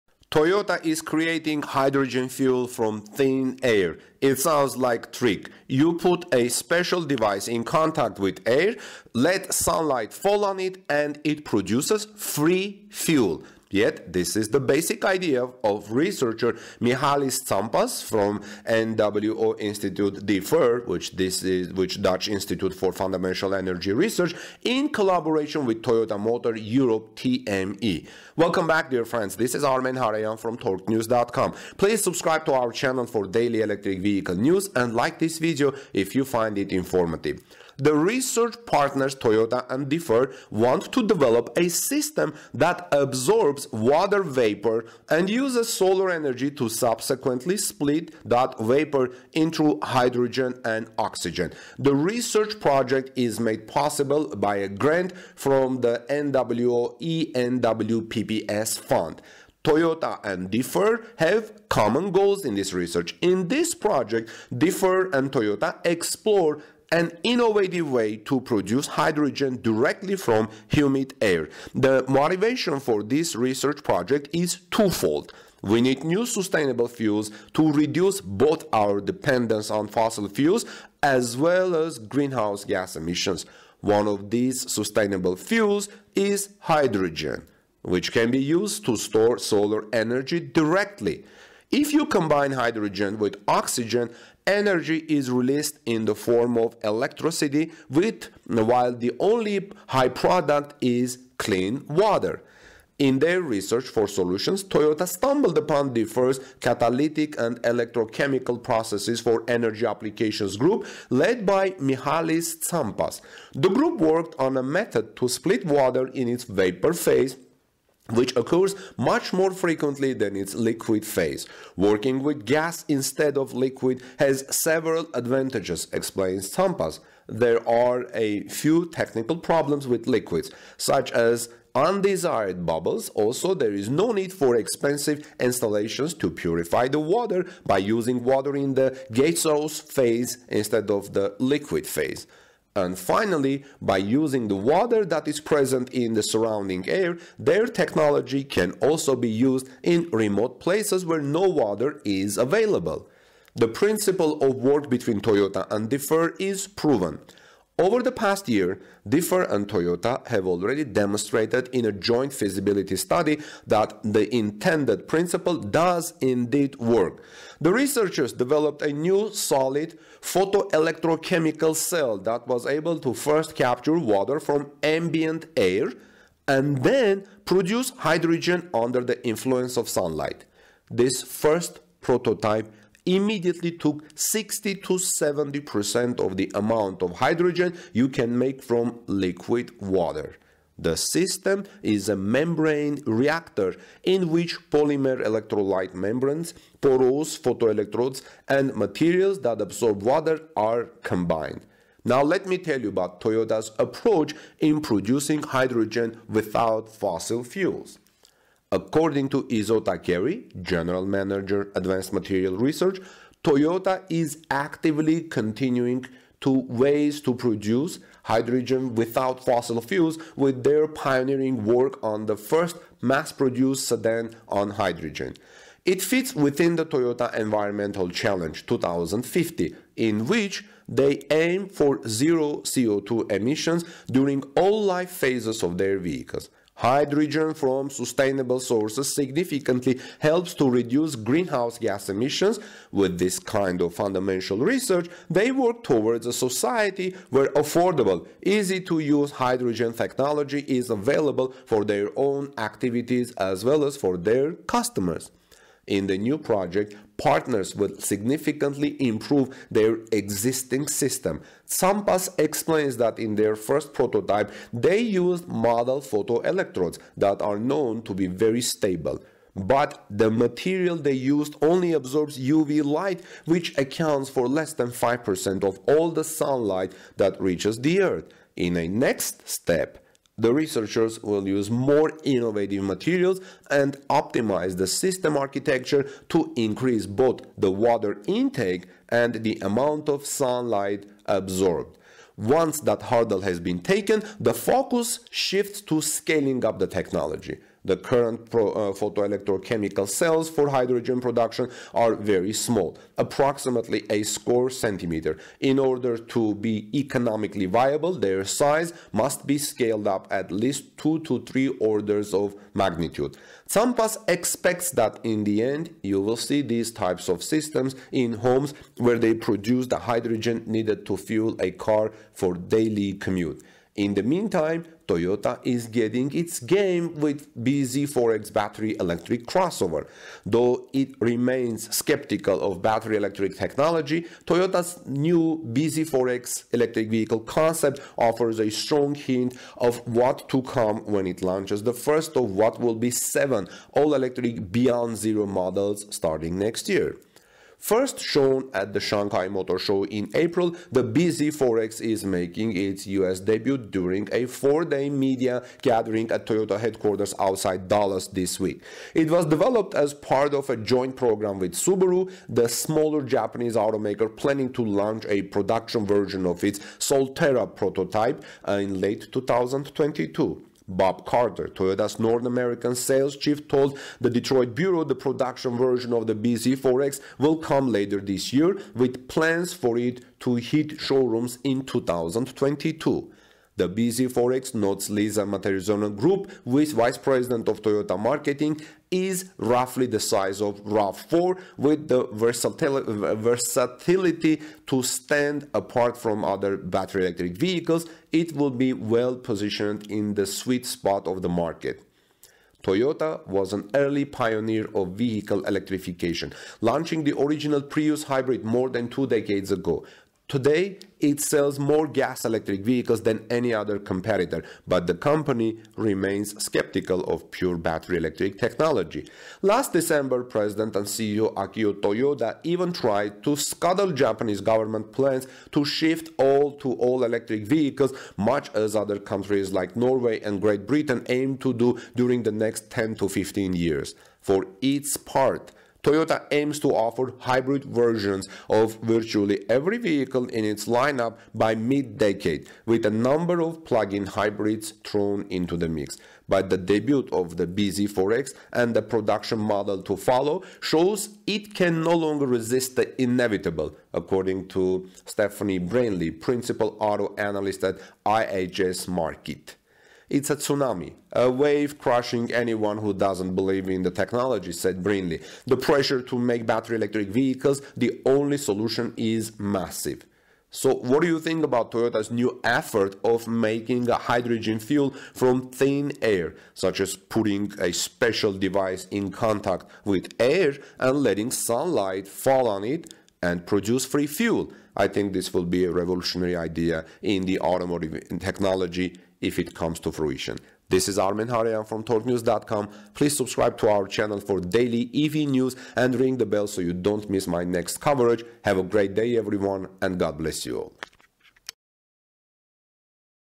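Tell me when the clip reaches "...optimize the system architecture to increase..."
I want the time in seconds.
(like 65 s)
284 s.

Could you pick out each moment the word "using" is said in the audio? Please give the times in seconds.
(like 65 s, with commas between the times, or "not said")
137 s, 143 s.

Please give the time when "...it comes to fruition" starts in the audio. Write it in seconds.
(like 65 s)
489 s.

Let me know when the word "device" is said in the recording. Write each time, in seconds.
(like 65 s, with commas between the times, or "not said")
7 s, 478 s.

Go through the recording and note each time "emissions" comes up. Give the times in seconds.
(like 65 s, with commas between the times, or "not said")
82 s, 233 s, 242 s.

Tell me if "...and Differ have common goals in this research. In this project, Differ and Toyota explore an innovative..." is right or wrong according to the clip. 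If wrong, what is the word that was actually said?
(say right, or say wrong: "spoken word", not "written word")
right.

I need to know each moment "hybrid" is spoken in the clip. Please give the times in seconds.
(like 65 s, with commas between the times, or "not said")
408 s, 437 s, 444 s.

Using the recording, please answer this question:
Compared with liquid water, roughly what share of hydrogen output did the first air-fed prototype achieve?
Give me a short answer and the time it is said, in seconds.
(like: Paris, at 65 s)
60 to 70%, at 184 s.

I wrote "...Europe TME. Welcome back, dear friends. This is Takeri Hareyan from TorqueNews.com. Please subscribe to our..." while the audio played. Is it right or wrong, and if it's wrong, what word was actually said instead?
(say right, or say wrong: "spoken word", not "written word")
wrong: "Armen", not "Takeri".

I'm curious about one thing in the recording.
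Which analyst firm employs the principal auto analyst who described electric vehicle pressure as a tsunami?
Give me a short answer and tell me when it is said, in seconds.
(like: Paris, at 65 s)
IHS Markit, at 458 s.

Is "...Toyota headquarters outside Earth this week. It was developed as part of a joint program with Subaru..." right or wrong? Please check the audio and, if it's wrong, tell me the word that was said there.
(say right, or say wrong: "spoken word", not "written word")
wrong: "Dallas", not "Earth".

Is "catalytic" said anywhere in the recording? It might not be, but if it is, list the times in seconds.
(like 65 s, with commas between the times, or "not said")
106 s.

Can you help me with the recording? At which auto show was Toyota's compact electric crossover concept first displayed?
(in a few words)
Shanghai Motor Show.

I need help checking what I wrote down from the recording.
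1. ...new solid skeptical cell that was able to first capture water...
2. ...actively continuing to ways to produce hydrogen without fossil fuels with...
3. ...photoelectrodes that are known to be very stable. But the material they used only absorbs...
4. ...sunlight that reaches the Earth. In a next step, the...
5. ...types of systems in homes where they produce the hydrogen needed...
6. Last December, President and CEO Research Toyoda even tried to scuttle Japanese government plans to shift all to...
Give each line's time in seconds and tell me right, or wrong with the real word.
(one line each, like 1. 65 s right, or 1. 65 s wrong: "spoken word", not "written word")
1. 168 s wrong: "photoelectrochemical", not "skeptical"
2. 214 s right
3. 266 s right
4. 276 s right
5. 316 s right
6. 419 s wrong: "Akio", not "Research".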